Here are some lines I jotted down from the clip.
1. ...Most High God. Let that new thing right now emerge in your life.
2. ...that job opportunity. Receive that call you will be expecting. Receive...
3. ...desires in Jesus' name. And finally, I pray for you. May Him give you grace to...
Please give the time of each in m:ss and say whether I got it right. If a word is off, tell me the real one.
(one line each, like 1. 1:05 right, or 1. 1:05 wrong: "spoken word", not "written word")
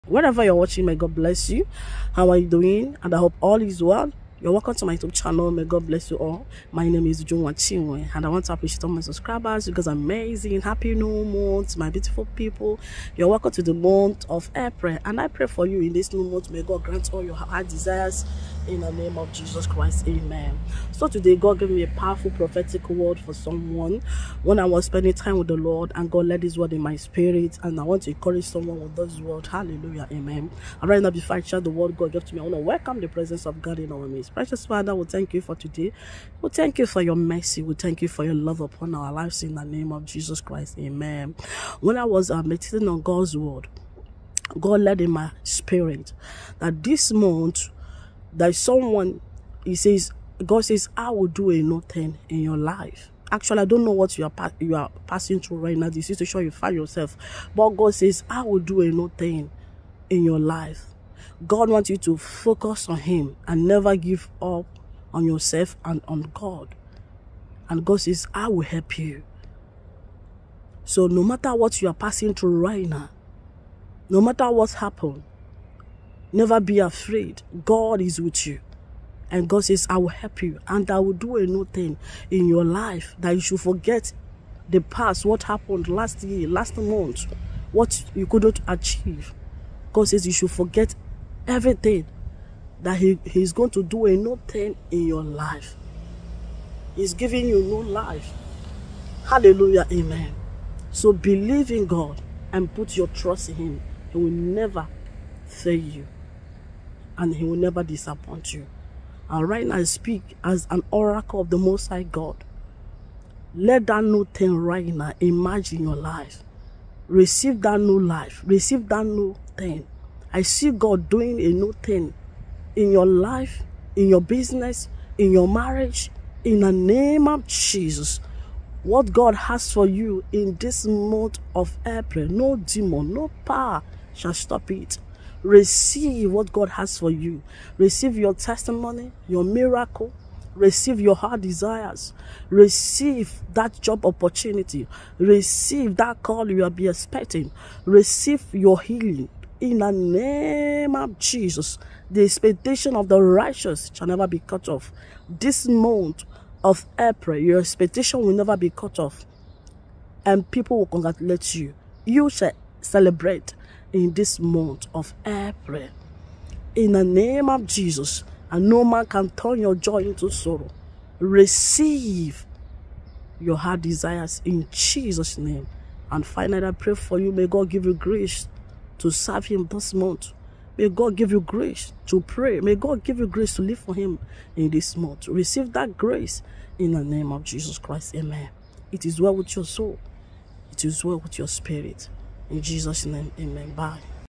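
1. 1:51 right
2. 2:23 right
3. 2:53 wrong: "God", not "Him".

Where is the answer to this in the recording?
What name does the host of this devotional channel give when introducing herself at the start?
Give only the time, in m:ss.
0:07.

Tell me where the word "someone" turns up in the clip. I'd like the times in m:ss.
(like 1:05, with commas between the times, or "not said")
0:23, 0:28, 0:48.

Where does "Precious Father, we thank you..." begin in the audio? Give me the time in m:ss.
0:34.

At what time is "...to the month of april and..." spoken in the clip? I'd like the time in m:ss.
0:13.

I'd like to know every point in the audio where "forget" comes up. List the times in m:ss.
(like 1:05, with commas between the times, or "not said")
1:23, 1:30.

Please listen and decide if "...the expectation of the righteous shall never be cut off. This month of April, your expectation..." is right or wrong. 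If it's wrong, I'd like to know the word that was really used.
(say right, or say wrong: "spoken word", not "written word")
right.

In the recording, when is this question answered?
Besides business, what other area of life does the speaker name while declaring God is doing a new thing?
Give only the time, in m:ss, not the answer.
2:05.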